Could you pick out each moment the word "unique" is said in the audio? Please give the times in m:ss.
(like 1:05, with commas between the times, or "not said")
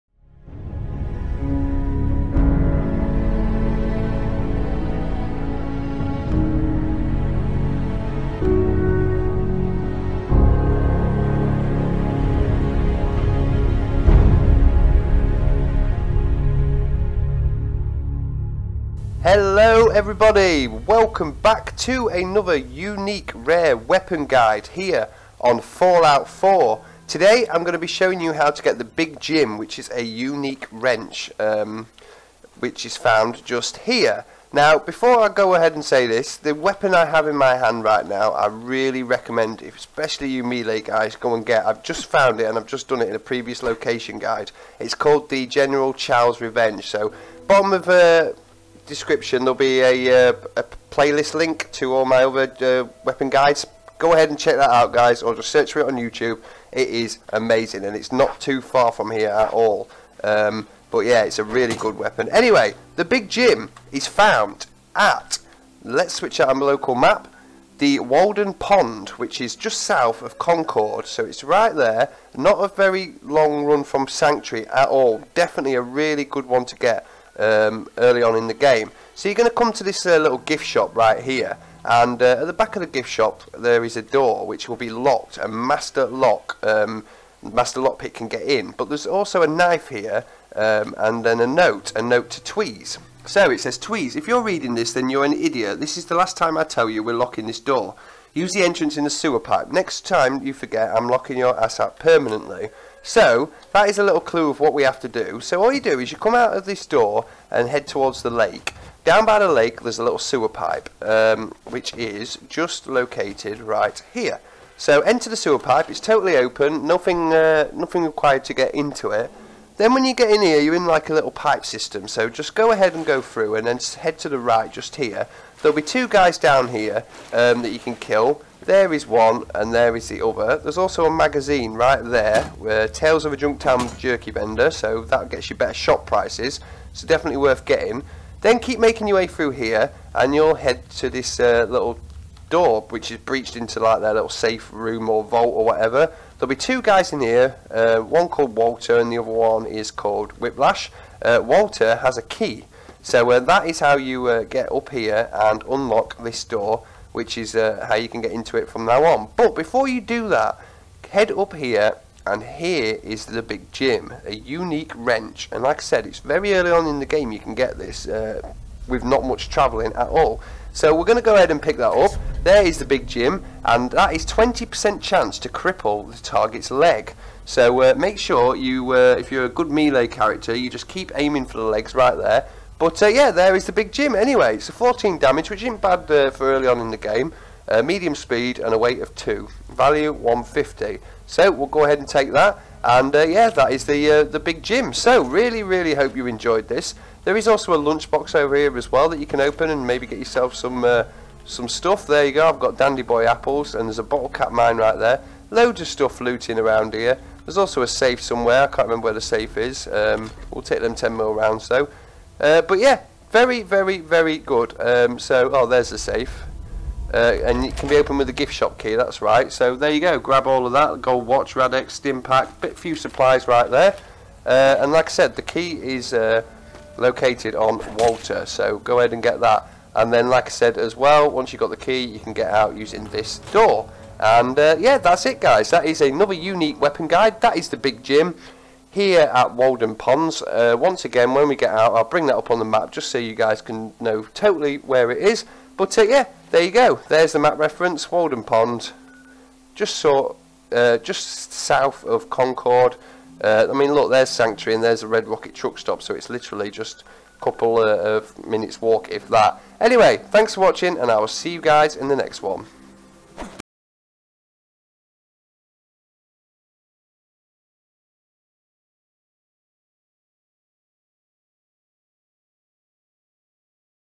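0:22, 0:30, 2:44, 3:56.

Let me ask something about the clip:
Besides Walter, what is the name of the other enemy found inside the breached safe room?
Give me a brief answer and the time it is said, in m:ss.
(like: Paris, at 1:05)
Whiplash, at 2:30.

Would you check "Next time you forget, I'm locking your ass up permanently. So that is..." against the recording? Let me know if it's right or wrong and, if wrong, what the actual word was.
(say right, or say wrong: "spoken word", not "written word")
right.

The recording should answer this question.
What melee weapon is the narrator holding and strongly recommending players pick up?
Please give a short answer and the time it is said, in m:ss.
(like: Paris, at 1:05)
General Chao's Revenge, at 0:45.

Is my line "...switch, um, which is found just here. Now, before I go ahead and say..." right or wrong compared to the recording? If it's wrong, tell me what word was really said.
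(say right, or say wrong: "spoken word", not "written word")
wrong: "wrench", not "switch".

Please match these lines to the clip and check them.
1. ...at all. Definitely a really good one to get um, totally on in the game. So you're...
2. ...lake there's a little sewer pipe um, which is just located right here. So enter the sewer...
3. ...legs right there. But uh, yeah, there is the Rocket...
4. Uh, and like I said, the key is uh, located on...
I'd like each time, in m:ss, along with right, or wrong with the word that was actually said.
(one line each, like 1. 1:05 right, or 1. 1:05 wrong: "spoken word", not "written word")
1. 1:14 wrong: "early", not "totally"
2. 1:49 right
3. 3:01 wrong: "Big", not "Rocket"
4. 3:44 right.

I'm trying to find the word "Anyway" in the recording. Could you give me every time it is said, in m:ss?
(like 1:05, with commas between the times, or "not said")
1:02, 3:04, 4:19.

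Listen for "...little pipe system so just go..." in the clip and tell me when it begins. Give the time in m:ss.
2:01.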